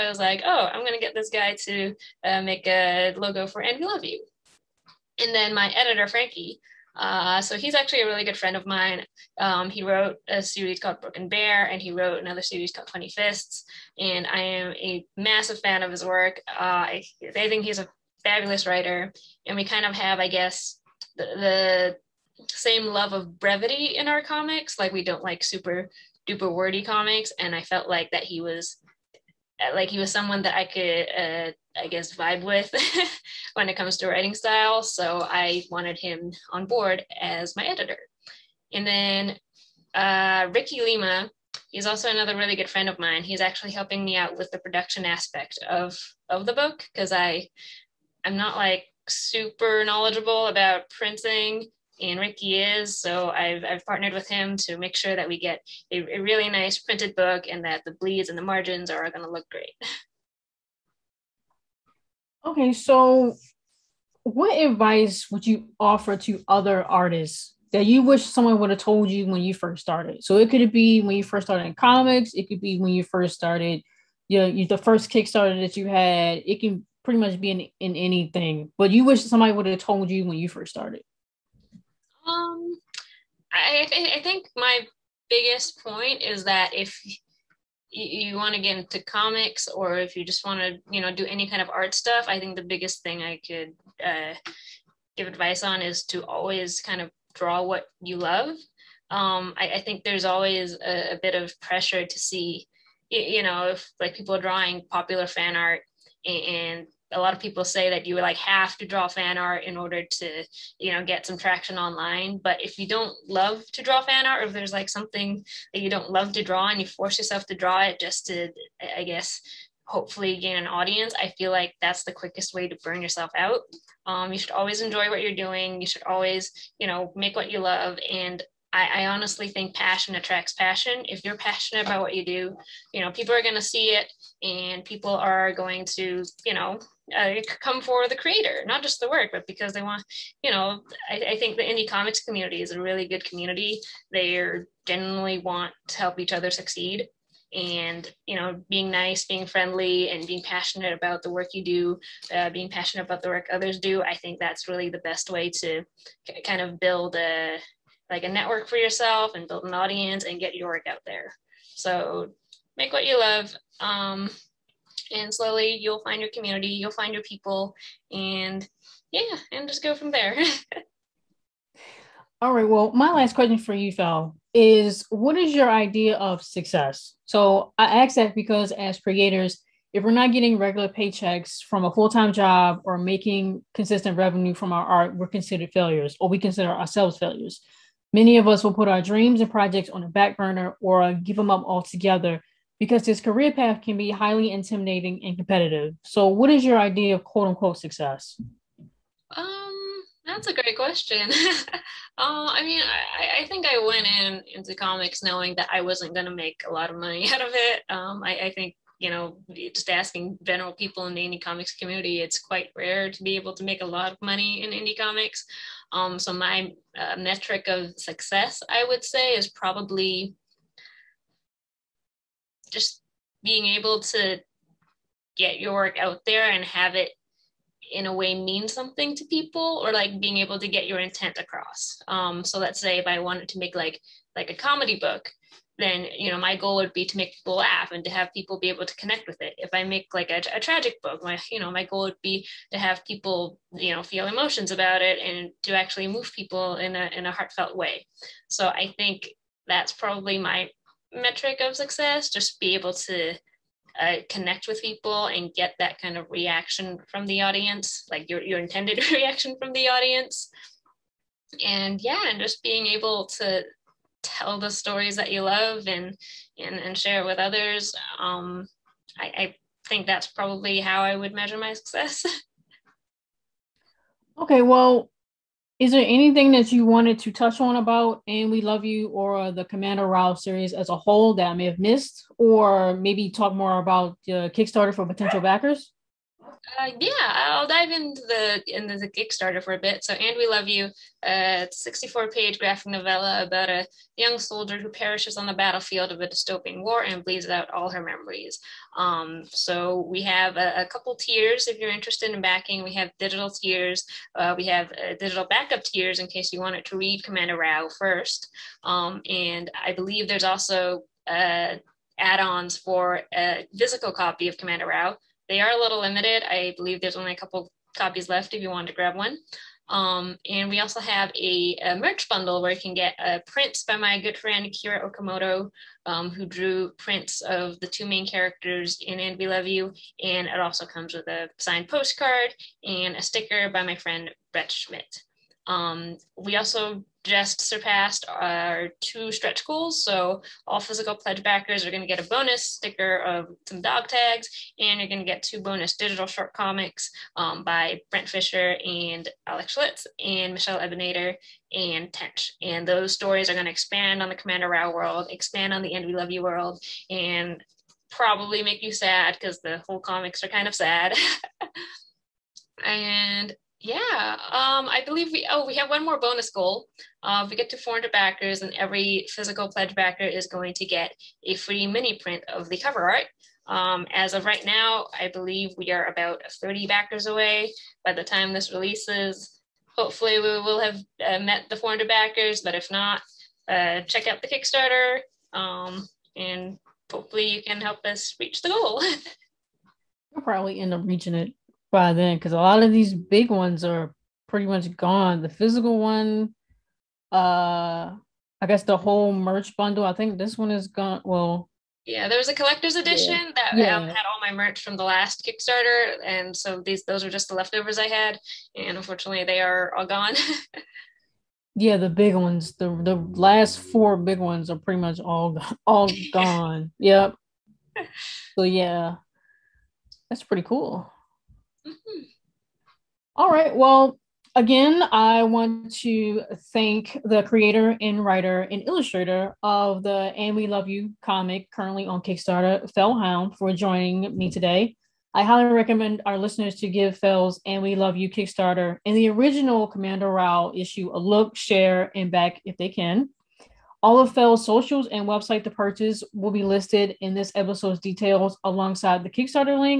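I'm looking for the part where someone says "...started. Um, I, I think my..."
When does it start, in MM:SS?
01:20.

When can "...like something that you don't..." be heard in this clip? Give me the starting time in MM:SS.
01:54.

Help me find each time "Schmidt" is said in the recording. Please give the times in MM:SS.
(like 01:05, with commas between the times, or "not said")
05:34.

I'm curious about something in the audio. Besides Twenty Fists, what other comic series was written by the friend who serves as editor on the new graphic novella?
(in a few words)
Broken Bear.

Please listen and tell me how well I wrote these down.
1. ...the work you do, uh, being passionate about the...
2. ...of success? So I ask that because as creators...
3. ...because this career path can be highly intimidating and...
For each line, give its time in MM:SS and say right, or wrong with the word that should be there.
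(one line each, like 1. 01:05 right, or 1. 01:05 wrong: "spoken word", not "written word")
1. 02:31 right
2. 02:56 right
3. 03:12 right.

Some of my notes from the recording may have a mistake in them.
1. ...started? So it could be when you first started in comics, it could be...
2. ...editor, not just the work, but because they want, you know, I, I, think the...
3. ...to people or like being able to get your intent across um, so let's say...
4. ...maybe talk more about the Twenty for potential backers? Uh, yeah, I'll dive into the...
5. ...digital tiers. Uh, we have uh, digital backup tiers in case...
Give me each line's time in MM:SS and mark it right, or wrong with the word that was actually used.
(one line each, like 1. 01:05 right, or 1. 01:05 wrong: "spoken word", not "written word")
1. 01:09 right
2. 02:18 wrong: "creator", not "editor"
3. 03:49 right
4. 04:42 wrong: "Kickstarter", not "Twenty"
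5. 05:03 right.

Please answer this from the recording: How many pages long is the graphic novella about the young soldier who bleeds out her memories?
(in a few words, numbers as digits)
64.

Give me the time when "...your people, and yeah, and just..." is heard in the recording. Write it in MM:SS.
02:47.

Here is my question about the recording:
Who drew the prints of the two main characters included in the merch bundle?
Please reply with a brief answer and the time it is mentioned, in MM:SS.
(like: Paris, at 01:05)
Kira Okamoto, at 05:24.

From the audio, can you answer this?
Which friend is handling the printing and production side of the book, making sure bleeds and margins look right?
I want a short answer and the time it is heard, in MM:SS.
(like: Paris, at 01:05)
Ricky Lima, at 00:40.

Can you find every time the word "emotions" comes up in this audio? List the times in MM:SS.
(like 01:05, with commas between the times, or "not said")
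04:04.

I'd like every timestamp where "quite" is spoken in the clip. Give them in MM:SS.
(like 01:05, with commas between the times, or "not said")
03:32.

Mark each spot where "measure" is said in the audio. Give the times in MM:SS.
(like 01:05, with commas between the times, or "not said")
04:31.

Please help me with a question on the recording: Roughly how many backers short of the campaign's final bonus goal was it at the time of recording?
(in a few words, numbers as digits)
30.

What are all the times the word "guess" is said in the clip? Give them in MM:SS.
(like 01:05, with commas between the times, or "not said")
00:20, 00:31, 01:59, 06:38.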